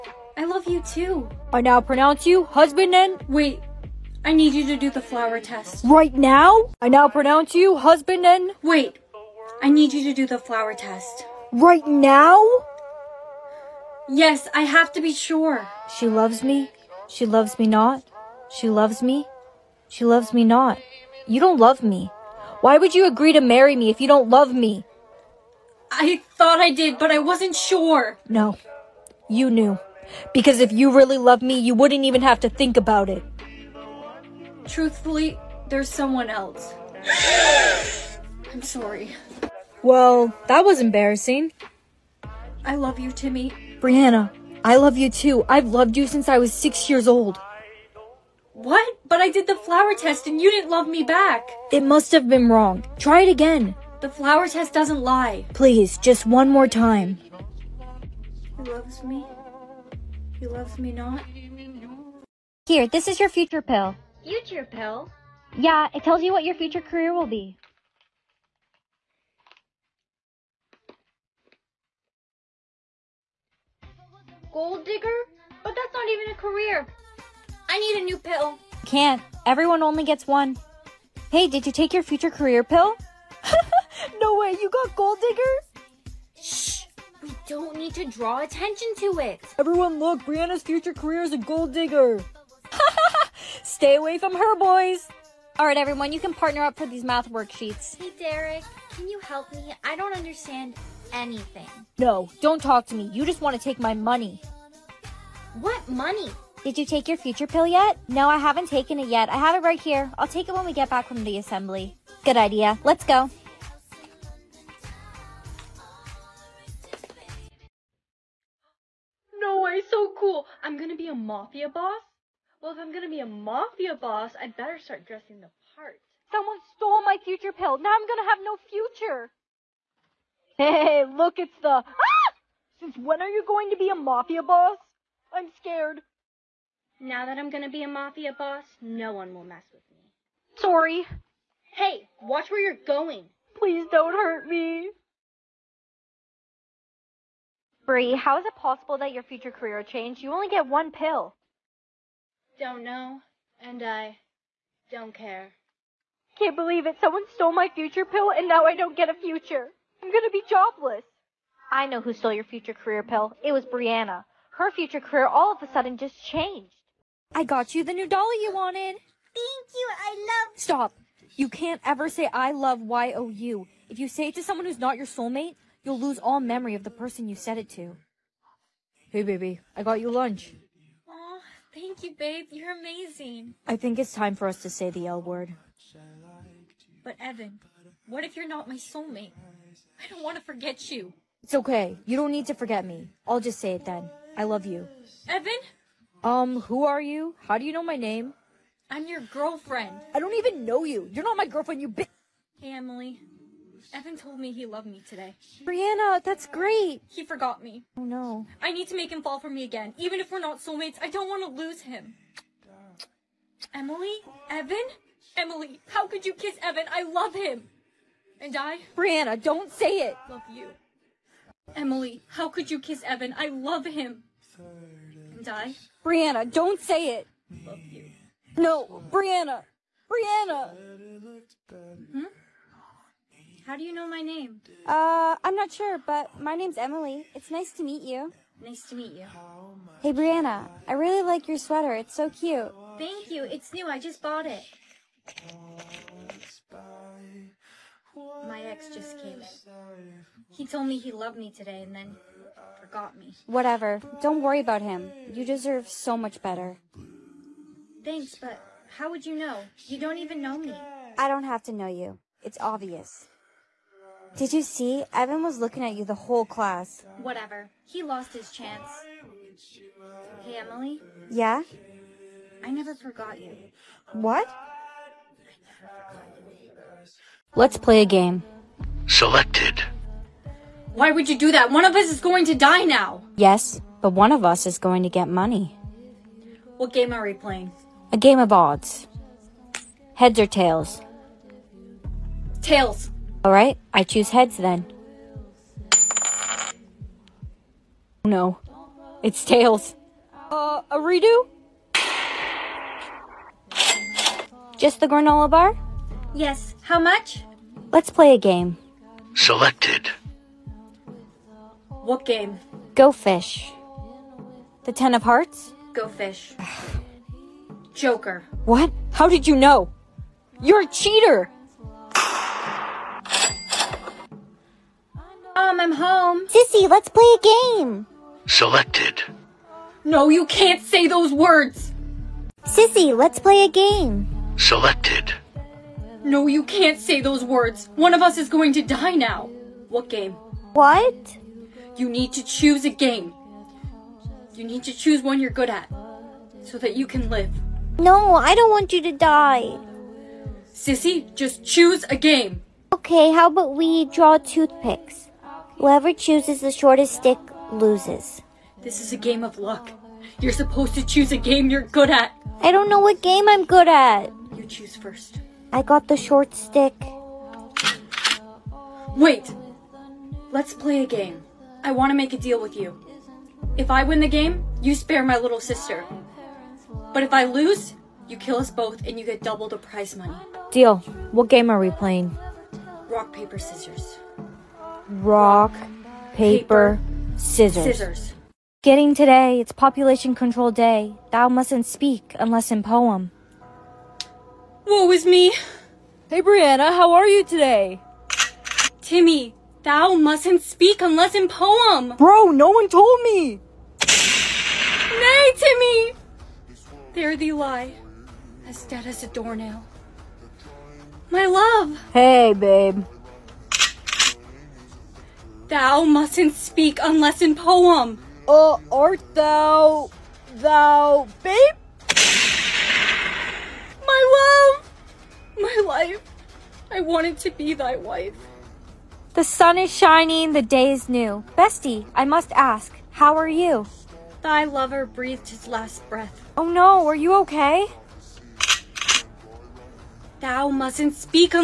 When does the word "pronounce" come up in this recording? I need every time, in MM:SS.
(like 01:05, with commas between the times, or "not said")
00:01, 00:07.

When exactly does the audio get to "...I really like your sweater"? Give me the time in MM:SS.
04:00.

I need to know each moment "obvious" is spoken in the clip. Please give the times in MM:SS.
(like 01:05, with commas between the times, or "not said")
04:22.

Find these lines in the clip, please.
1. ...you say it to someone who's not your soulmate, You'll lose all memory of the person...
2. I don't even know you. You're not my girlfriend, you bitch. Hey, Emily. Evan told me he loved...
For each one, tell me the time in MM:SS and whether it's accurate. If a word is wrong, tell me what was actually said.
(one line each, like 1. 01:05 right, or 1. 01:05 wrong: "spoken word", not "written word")
1. 02:53 right
2. 03:20 right.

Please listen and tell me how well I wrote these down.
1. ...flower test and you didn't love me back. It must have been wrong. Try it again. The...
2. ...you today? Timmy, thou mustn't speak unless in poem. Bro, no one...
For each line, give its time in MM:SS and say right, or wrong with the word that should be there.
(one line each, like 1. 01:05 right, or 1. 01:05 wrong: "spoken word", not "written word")
1. 00:49 right
2. 06:37 right.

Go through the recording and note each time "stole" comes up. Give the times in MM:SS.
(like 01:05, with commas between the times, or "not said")
02:06, 02:37, 02:42.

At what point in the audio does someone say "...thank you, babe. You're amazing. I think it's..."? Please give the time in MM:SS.
03:01.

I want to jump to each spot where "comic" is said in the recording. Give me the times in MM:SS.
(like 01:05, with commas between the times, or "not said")
not said.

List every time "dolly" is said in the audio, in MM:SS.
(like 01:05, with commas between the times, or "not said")
02:48.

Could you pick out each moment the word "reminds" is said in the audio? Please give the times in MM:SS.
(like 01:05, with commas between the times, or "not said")
not said.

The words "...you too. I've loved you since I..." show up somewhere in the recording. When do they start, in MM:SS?
00:44.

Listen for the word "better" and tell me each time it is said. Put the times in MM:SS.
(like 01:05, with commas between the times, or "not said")
02:04, 04:16.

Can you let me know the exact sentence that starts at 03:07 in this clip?
But, Evan, what if you're not my soulmate?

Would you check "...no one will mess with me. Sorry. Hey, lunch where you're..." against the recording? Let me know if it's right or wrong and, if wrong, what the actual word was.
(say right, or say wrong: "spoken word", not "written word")
wrong: "watch", not "lunch".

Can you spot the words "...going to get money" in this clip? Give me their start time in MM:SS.
04:44.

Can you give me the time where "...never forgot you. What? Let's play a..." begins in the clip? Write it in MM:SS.
04:32.